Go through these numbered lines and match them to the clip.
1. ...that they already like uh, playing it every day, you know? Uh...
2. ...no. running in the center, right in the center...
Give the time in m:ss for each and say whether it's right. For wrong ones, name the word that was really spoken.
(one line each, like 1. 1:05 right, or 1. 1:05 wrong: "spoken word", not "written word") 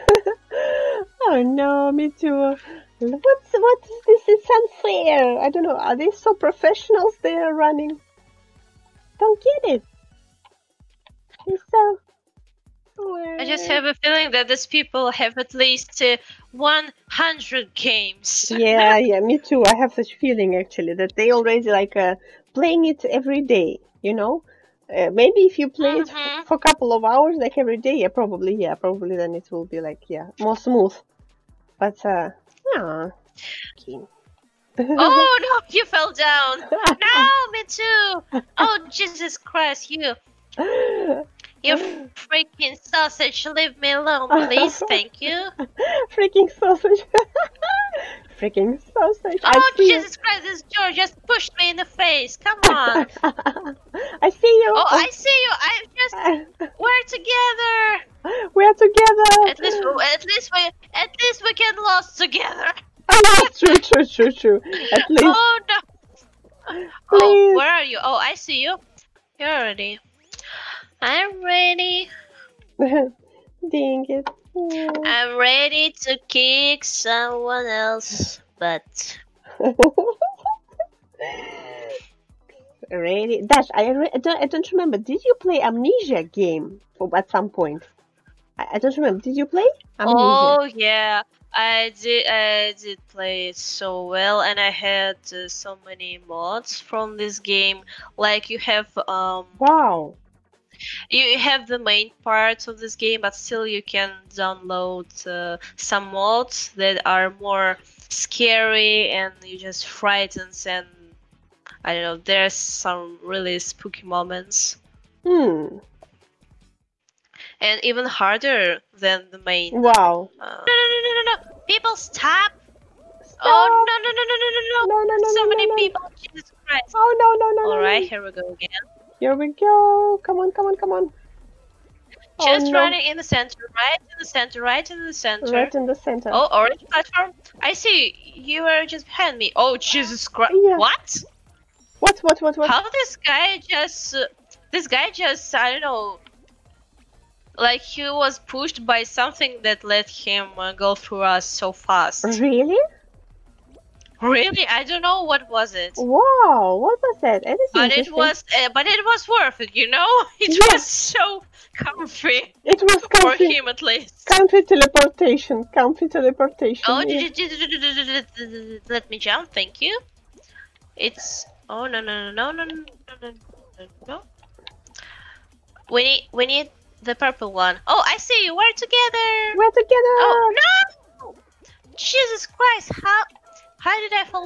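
1. 0:20 right
2. 2:12 right.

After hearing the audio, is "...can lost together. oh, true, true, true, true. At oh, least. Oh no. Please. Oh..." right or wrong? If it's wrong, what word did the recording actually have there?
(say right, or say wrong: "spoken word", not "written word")
right.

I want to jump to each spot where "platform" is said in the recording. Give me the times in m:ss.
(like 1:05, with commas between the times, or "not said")
2:16.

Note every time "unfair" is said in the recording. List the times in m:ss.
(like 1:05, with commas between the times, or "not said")
0:04.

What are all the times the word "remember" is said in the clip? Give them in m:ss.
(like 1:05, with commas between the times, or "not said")
1:24, 1:28.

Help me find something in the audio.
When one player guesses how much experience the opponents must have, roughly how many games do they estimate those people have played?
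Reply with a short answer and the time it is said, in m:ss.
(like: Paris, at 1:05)
100, at 0:16.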